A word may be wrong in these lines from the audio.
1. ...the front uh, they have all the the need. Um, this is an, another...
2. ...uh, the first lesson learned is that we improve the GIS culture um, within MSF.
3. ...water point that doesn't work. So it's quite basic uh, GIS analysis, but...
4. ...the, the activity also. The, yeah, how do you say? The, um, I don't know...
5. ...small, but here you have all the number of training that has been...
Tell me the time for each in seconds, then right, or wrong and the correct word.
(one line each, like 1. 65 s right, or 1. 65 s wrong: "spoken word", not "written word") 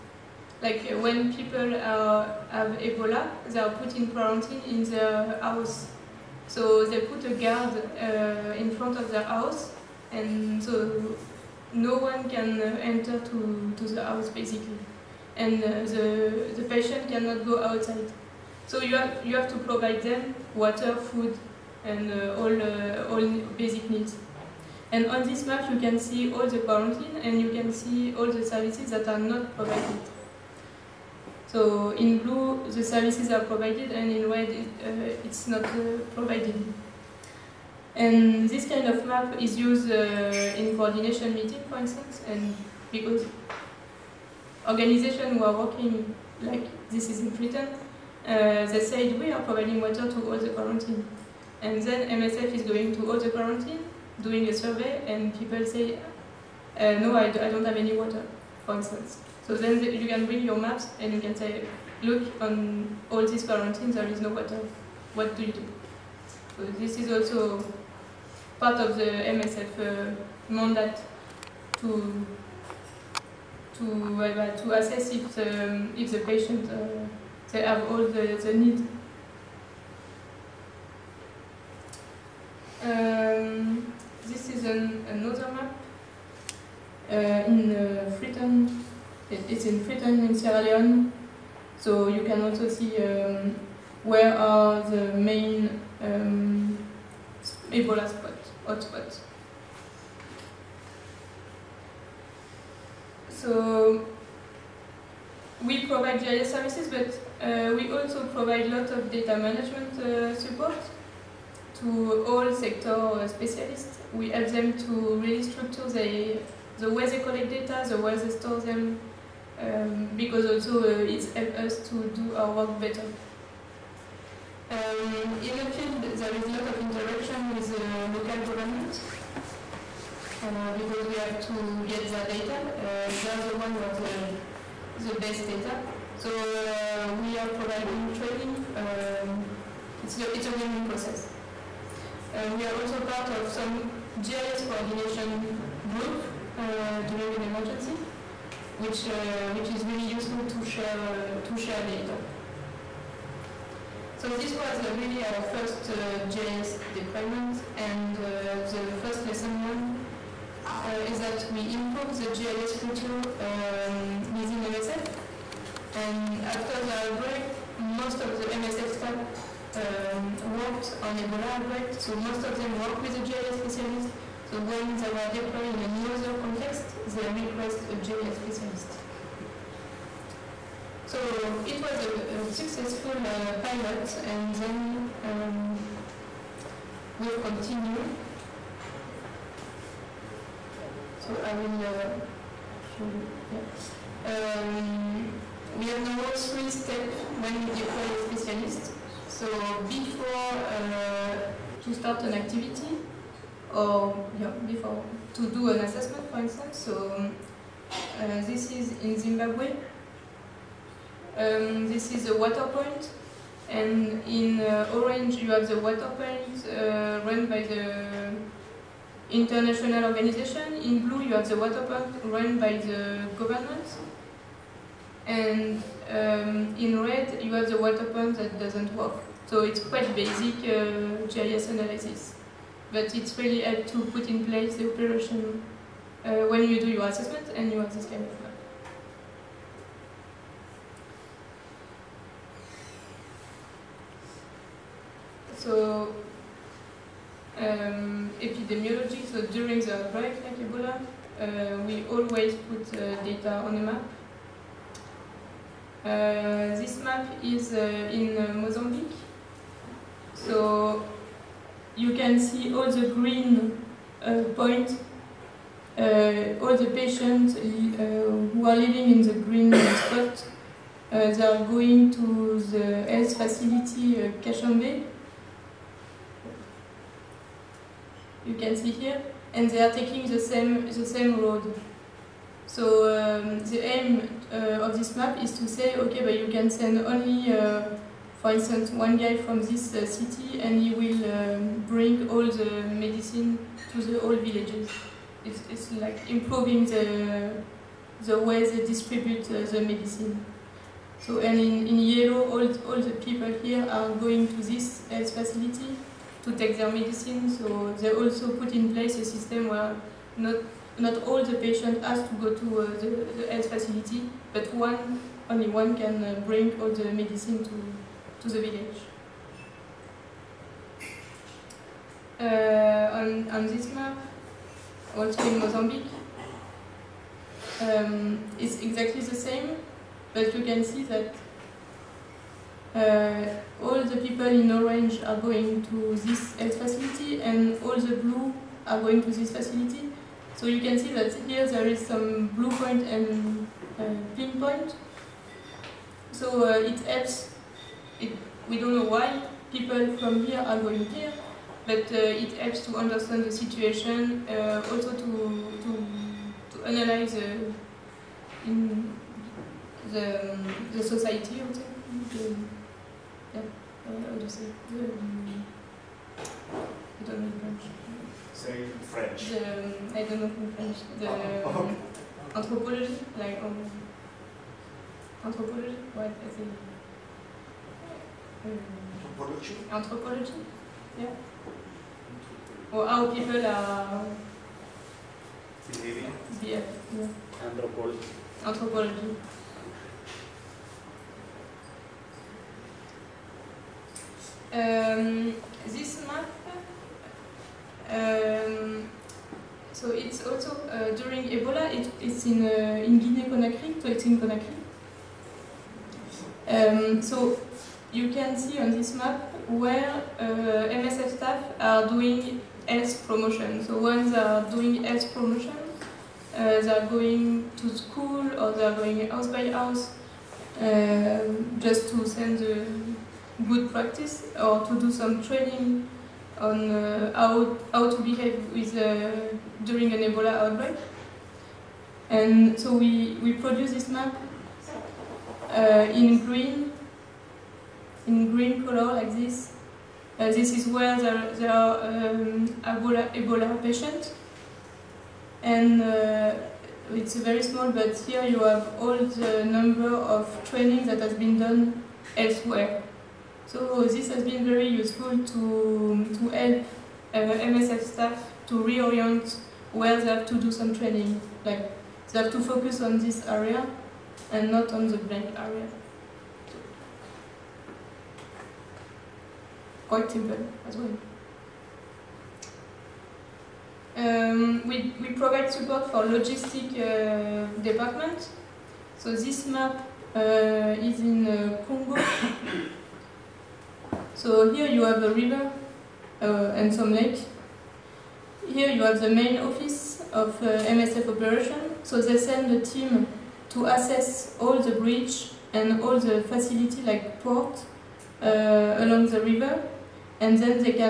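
1. 76 s wrong: "patient", not "front"
2. 158 s right
3. 227 s right
4. 360 s wrong: "society", not "activity"
5. 447 s right.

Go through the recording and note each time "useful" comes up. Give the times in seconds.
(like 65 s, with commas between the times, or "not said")
150 s, 454 s.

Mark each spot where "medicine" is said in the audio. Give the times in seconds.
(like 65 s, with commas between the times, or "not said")
292 s, 299 s, 306 s, 317 s.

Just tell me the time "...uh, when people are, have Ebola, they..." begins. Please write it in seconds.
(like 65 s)
0 s.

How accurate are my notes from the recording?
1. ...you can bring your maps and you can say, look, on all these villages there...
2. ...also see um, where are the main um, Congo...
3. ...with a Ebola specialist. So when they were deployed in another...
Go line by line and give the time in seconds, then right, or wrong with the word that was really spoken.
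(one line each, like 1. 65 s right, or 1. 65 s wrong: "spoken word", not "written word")
1. 59 s wrong: "quarantines", not "villages"
2. 92 s wrong: "Ebola", not "Congo"
3. 173 s wrong: "GIS", not "Ebola".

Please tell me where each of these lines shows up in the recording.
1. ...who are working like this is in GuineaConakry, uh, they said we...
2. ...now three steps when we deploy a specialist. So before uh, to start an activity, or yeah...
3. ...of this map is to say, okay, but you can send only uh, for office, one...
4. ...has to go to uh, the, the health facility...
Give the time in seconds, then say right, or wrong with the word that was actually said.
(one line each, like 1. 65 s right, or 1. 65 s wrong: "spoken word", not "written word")
1. 45 s wrong: "Britain", not "GuineaConakry"
2. 196 s right
3. 284 s wrong: "instance", not "office"
4. 312 s right.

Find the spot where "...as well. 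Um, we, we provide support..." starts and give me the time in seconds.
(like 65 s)
470 s.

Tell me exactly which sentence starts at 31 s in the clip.
So in blue, the services are provided and in red, it, uh, it's not uh, provided.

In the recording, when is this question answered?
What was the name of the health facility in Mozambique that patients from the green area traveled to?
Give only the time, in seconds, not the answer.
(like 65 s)
274 s.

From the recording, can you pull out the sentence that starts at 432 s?
And so we, we produce this map uh, in green in green color like this.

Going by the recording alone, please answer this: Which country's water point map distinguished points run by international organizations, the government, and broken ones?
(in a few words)
Zimbabwe.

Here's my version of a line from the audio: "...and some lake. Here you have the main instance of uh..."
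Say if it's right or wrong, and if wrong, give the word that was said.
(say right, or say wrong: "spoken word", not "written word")
wrong: "office", not "instance".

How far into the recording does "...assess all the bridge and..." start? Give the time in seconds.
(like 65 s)
493 s.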